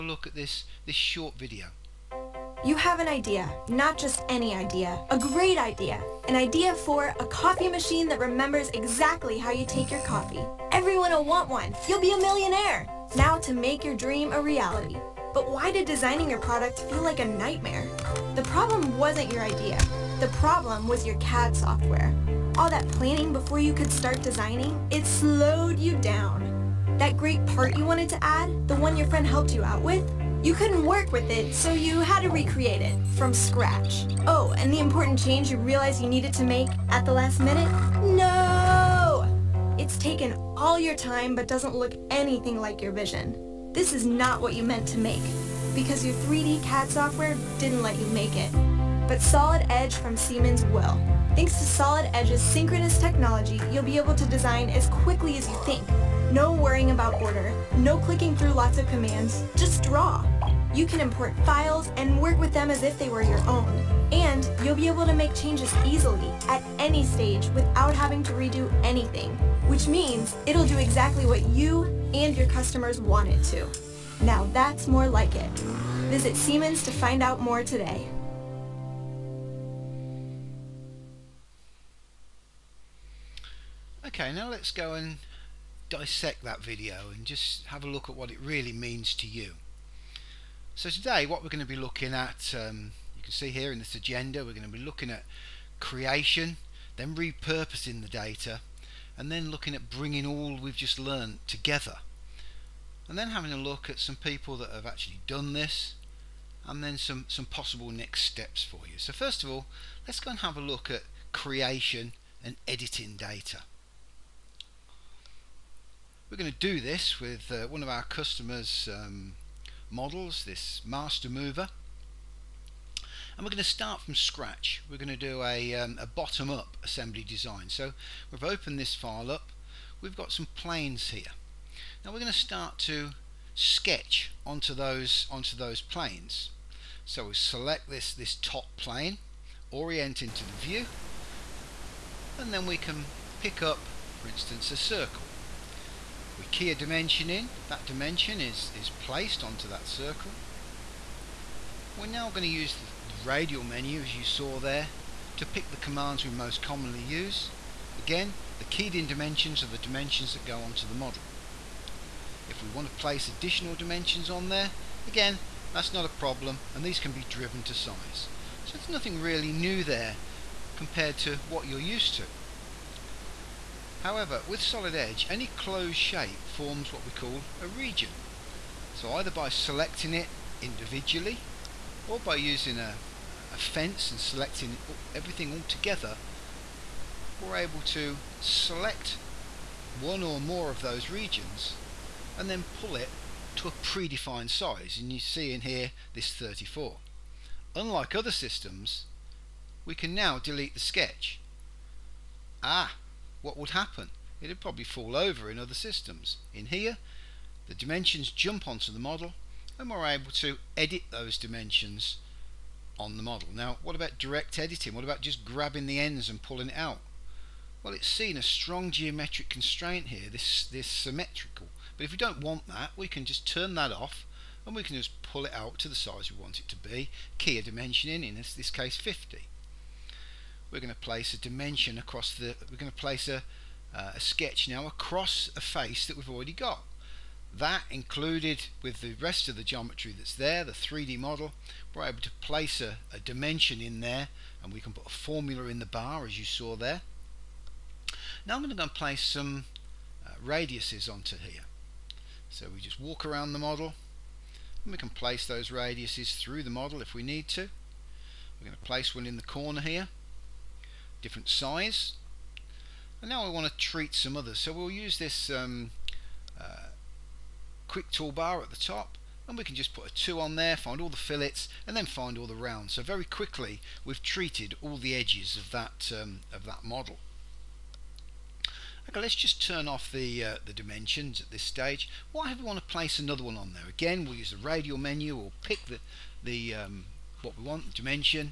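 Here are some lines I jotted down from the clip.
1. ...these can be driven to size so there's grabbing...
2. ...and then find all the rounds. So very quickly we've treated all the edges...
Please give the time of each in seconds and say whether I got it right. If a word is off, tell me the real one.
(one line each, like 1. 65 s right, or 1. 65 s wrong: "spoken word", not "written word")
1. 166 s wrong: "nothing", not "grabbing"
2. 271 s right.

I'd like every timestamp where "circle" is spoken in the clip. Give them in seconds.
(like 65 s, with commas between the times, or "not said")
144 s, 149 s.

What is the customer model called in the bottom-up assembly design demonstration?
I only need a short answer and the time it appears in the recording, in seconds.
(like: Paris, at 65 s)
Master mover, at 120 s.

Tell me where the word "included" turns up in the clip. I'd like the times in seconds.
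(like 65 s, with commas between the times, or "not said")
237 s.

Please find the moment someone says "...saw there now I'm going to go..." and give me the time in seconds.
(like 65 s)
246 s.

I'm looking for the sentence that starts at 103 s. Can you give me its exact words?
And then having a look at some people that have actually done this, and then some, some possible next steps for you.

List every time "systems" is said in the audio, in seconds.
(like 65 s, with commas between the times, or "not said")
198 s, 205 s.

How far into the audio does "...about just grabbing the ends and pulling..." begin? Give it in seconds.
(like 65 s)
215 s.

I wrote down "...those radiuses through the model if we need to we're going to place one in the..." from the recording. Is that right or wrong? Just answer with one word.
right.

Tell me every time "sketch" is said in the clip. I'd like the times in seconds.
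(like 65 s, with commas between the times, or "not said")
133 s, 200 s, 234 s.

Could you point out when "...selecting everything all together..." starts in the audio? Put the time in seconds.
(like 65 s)
184 s.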